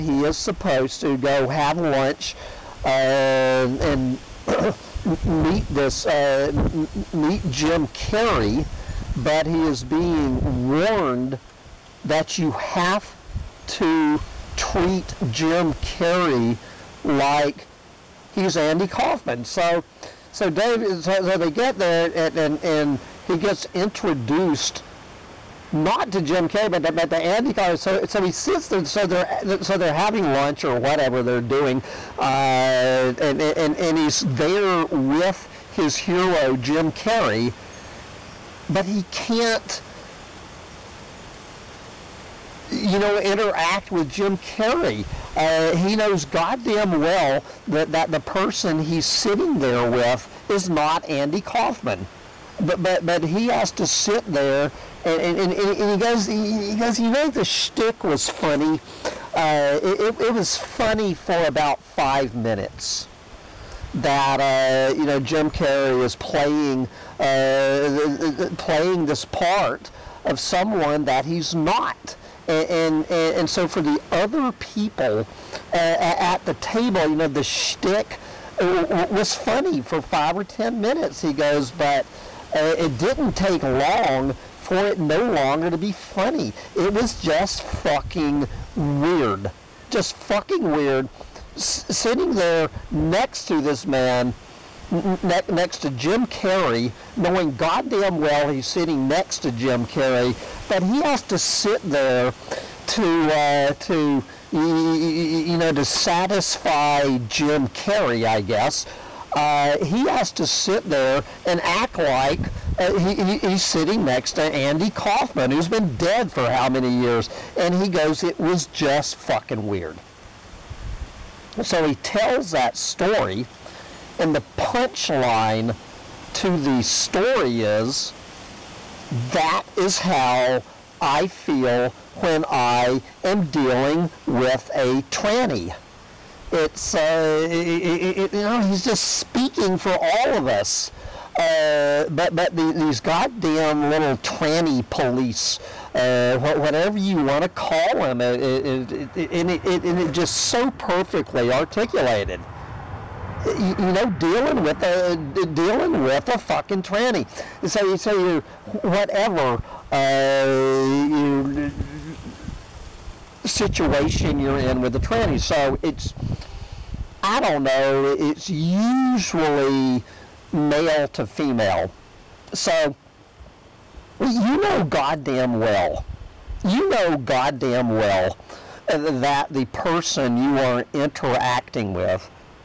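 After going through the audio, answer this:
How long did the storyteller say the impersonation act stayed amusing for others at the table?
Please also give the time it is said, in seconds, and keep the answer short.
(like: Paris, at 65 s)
5 or 10 minutes, at 80 s.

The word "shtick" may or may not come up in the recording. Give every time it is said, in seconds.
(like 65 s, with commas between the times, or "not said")
57 s, 77 s.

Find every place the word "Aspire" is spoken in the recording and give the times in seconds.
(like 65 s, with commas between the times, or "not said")
not said.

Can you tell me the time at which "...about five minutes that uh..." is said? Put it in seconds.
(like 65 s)
61 s.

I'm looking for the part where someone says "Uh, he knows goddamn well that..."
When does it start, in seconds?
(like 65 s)
45 s.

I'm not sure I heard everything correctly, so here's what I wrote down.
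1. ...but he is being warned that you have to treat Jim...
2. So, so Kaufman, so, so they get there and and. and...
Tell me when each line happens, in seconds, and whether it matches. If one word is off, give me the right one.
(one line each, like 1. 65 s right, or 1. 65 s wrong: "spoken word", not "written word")
1. 9 s right
2. 19 s wrong: "Dave", not "Kaufman".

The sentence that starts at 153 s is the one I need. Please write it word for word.
You, know, dealing with a dealing with a fucking tranny.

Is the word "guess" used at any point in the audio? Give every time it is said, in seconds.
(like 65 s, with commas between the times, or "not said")
108 s.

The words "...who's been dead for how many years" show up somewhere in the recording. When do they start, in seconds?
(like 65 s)
115 s.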